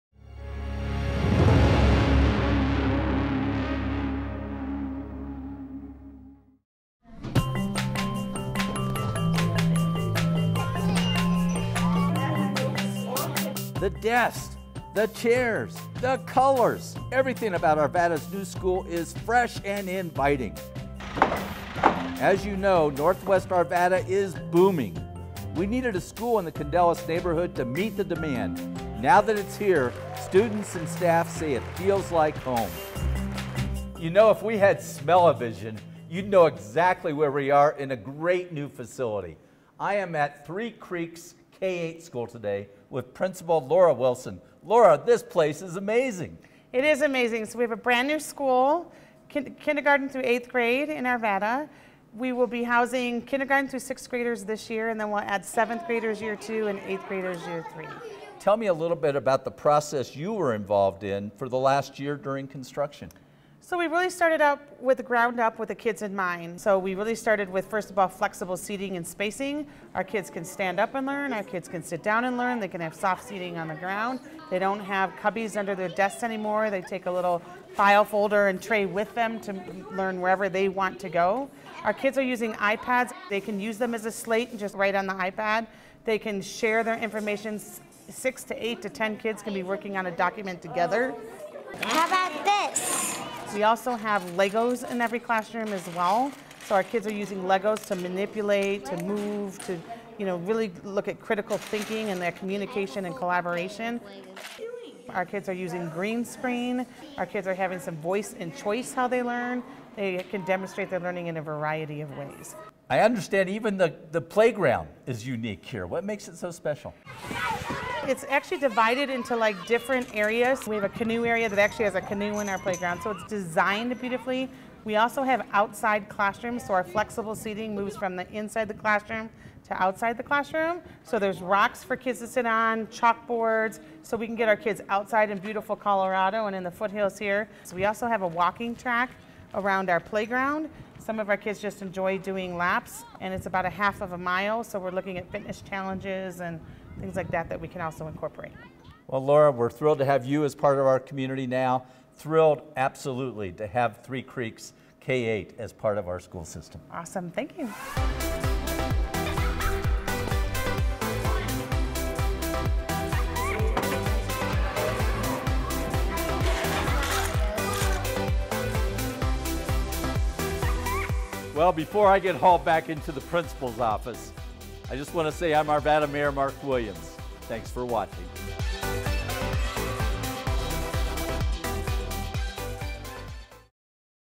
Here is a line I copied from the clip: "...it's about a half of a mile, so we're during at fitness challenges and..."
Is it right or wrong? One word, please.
wrong.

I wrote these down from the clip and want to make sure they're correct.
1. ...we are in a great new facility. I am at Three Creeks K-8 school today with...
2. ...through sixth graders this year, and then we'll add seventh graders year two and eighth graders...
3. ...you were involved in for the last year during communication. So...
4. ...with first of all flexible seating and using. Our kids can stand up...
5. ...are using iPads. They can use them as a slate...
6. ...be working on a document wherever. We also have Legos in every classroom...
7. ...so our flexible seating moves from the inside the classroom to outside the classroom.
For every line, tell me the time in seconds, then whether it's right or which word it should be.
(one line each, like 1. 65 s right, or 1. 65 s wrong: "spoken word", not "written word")
1. 37 s right
2. 53 s right
3. 60 s wrong: "construction", not "communication"
4. 67 s wrong: "spacing", not "using"
5. 82 s right
6. 89 s wrong: "together", not "wherever"
7. 126 s right.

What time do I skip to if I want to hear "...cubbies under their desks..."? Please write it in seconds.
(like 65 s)
75 s.